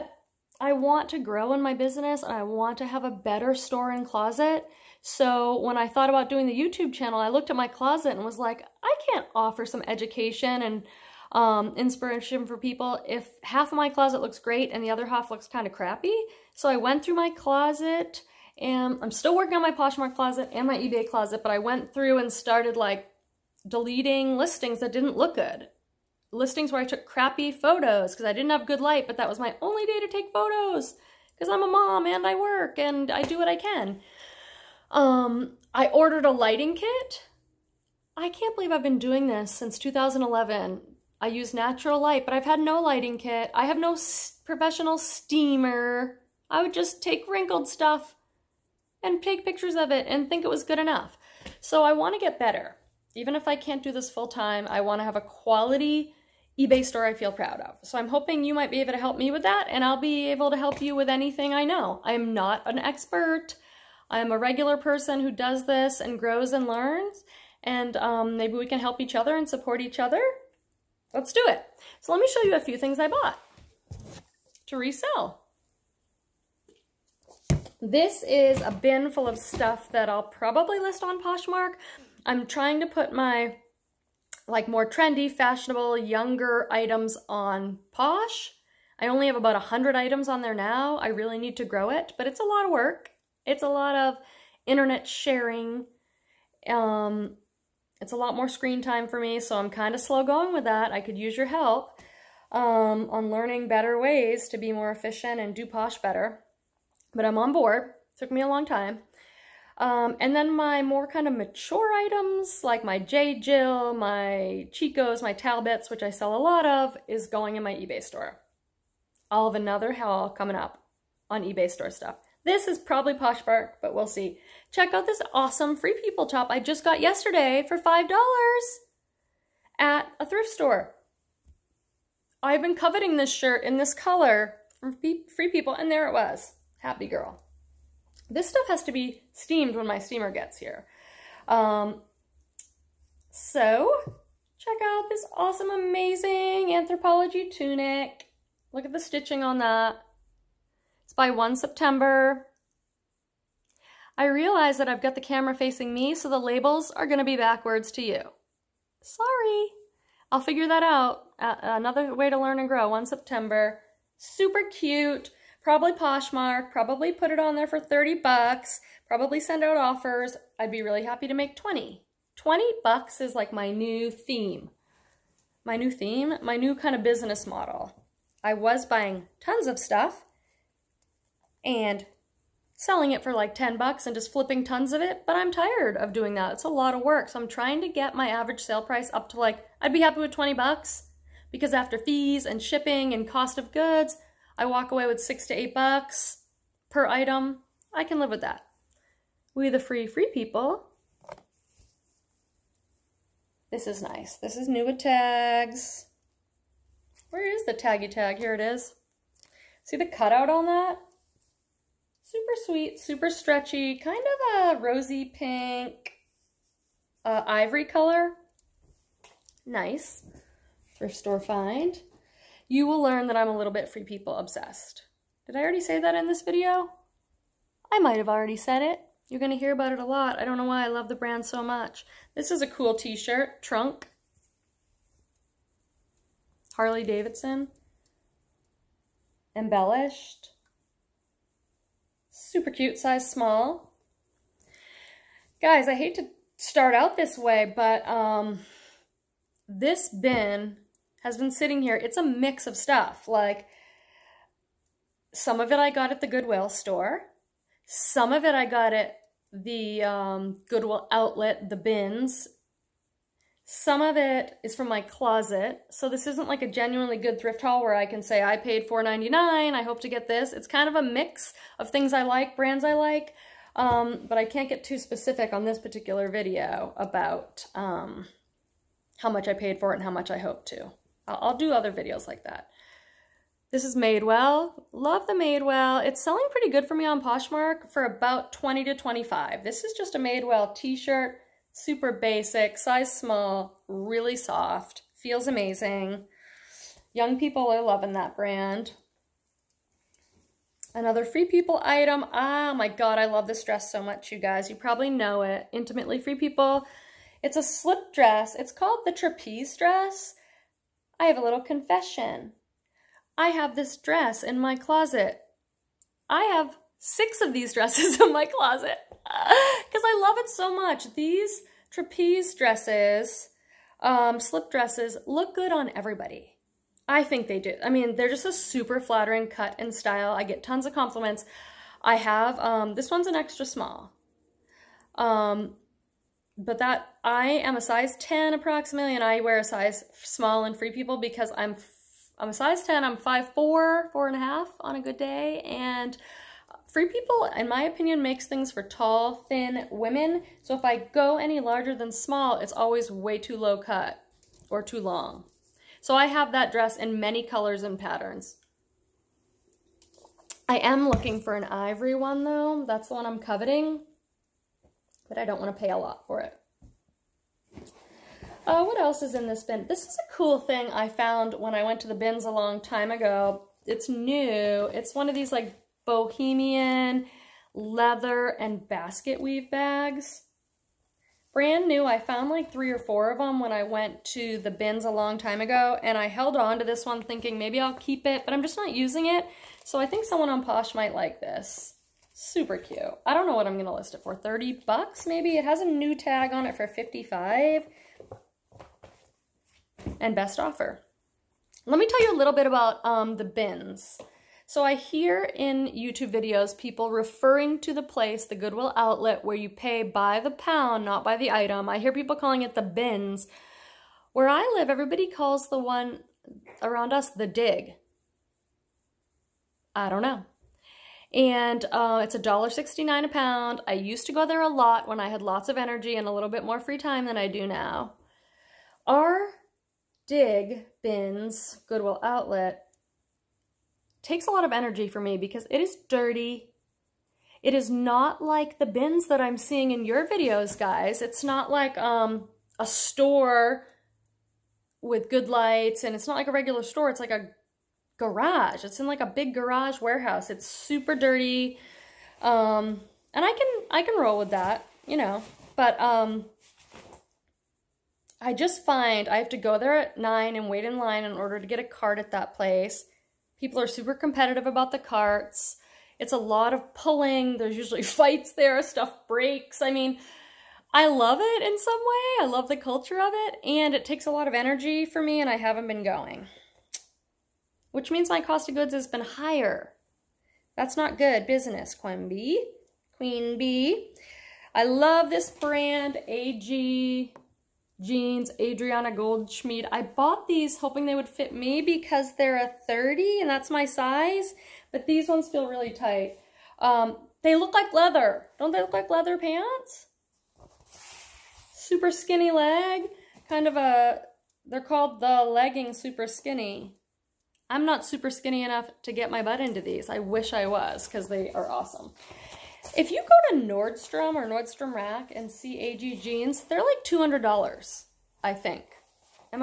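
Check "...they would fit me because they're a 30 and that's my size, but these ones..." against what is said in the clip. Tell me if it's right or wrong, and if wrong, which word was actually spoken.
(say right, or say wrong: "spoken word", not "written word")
right.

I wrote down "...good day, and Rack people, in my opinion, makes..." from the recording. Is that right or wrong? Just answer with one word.
wrong.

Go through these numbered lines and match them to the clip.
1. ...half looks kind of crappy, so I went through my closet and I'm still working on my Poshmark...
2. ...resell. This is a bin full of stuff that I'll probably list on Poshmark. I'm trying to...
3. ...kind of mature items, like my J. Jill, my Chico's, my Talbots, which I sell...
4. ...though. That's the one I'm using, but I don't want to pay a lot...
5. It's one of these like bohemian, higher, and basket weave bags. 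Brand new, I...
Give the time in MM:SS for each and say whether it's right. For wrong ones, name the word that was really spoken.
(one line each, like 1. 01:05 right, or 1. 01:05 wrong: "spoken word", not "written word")
1. 00:15 right
2. 01:14 right
3. 01:51 right
4. 06:02 wrong: "coveting", not "using"
5. 06:14 wrong: "leather", not "higher".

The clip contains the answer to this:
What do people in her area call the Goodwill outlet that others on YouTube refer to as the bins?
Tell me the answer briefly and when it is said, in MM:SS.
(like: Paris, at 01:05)
the dig, at 06:57.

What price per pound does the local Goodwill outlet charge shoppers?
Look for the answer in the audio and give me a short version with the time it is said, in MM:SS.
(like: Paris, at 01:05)
$1.69, at 07:02.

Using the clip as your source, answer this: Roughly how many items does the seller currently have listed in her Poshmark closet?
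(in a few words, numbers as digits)
100.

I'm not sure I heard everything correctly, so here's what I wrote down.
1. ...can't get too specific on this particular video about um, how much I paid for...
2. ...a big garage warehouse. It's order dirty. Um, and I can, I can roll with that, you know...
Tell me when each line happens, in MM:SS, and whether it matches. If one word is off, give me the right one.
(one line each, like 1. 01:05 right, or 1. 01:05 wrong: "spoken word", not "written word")
1. 04:34 right
2. 07:29 wrong: "super", not "order".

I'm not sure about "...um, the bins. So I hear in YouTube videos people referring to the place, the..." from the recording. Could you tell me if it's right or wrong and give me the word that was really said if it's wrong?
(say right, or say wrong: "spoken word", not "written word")
right.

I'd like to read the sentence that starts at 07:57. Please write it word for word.
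Which means my cost of goods has been higher.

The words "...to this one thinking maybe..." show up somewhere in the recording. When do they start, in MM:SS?
06:26.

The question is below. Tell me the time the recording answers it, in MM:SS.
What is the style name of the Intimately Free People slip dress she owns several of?
05:09.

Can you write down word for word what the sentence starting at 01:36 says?
Um, it's a lot more screen time for me, so I'm kind of slow going with that.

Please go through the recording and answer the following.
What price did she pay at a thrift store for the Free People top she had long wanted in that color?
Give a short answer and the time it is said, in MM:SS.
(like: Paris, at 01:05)
$5, at 02:07.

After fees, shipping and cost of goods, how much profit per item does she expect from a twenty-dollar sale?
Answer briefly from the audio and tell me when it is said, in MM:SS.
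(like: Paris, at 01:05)
6 to 8 dollars, at 03:15.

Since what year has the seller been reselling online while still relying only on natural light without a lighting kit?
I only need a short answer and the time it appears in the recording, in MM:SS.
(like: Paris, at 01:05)
2011, at 00:39.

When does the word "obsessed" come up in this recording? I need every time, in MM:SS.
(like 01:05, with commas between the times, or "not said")
03:44.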